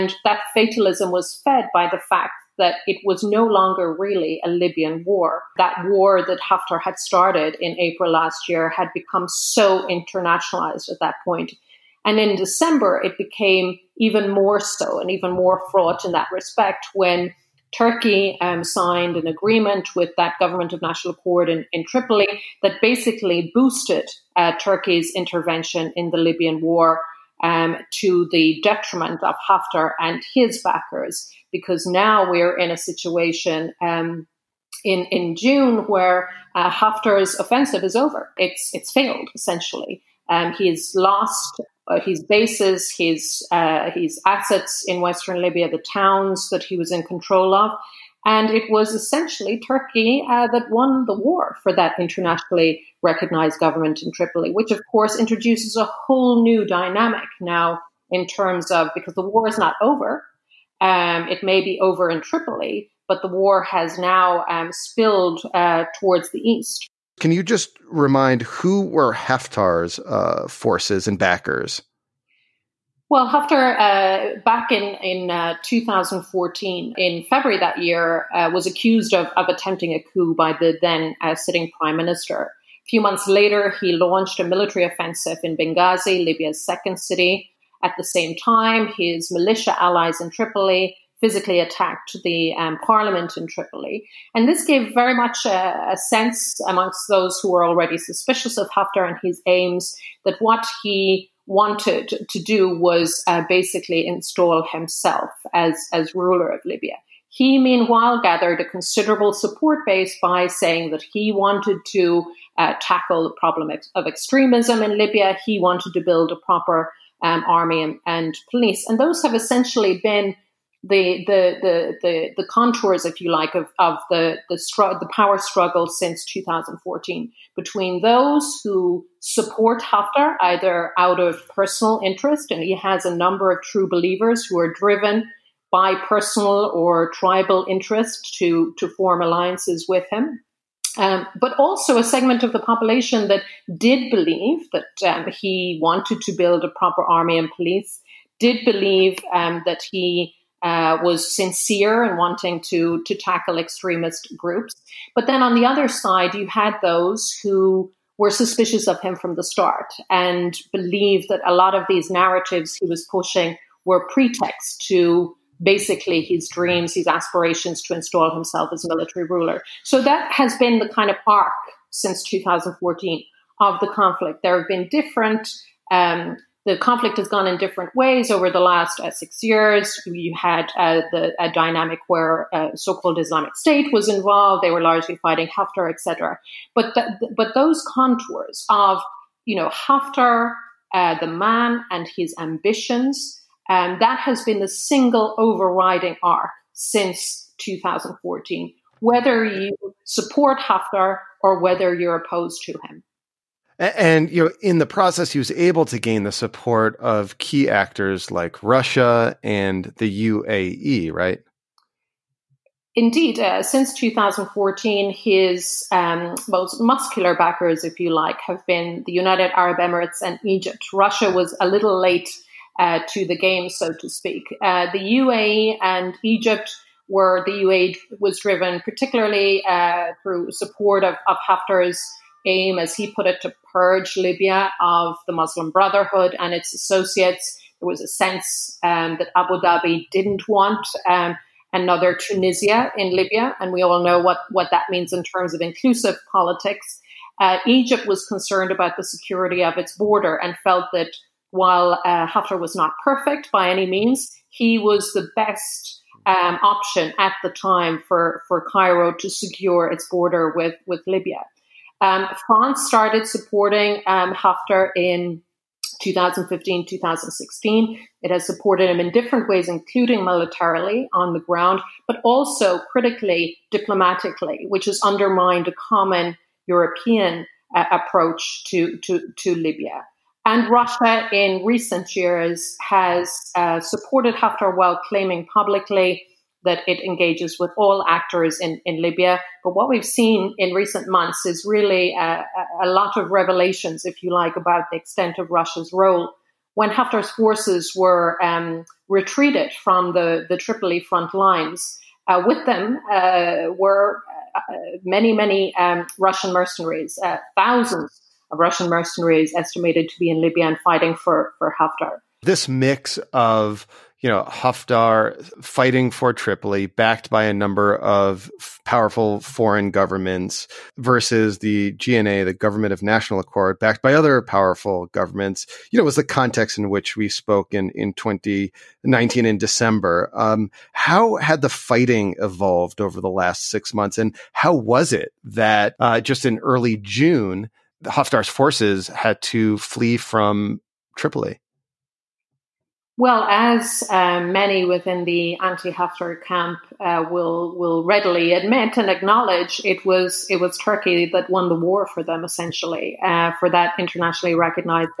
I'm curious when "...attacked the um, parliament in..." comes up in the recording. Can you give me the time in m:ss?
1:31.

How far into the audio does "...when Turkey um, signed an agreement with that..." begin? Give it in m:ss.
0:16.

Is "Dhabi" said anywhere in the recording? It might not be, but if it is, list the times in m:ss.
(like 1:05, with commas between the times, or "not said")
3:59.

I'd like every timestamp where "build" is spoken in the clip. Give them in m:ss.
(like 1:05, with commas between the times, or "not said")
1:56, 2:26.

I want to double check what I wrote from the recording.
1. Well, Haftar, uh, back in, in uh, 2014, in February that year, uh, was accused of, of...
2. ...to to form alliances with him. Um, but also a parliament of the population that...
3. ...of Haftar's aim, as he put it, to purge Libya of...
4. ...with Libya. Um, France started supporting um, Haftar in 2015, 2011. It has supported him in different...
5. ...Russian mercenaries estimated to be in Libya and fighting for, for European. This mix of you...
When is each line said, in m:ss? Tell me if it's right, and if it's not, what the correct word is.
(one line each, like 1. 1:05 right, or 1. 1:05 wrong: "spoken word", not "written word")
1. 1:13 right
2. 2:18 wrong: "segment", not "parliament"
3. 3:51 right
4. 4:20 wrong: "2016", not "2011"
5. 5:08 wrong: "Haftar", not "European".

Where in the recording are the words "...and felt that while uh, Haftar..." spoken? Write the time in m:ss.
4:10.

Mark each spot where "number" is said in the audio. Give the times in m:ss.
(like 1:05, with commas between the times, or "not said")
2:13, 5:17.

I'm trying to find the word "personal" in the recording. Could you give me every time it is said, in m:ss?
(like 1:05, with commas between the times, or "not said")
2:11, 2:16.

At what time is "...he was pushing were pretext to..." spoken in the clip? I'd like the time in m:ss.
2:42.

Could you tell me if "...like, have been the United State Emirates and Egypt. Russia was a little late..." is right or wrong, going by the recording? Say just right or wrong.
wrong.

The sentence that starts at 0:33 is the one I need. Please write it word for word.
Um, in, in June, where uh, Haftar's offensive is over, it's it's failed essentially.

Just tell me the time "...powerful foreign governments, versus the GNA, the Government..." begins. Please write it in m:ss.
5:18.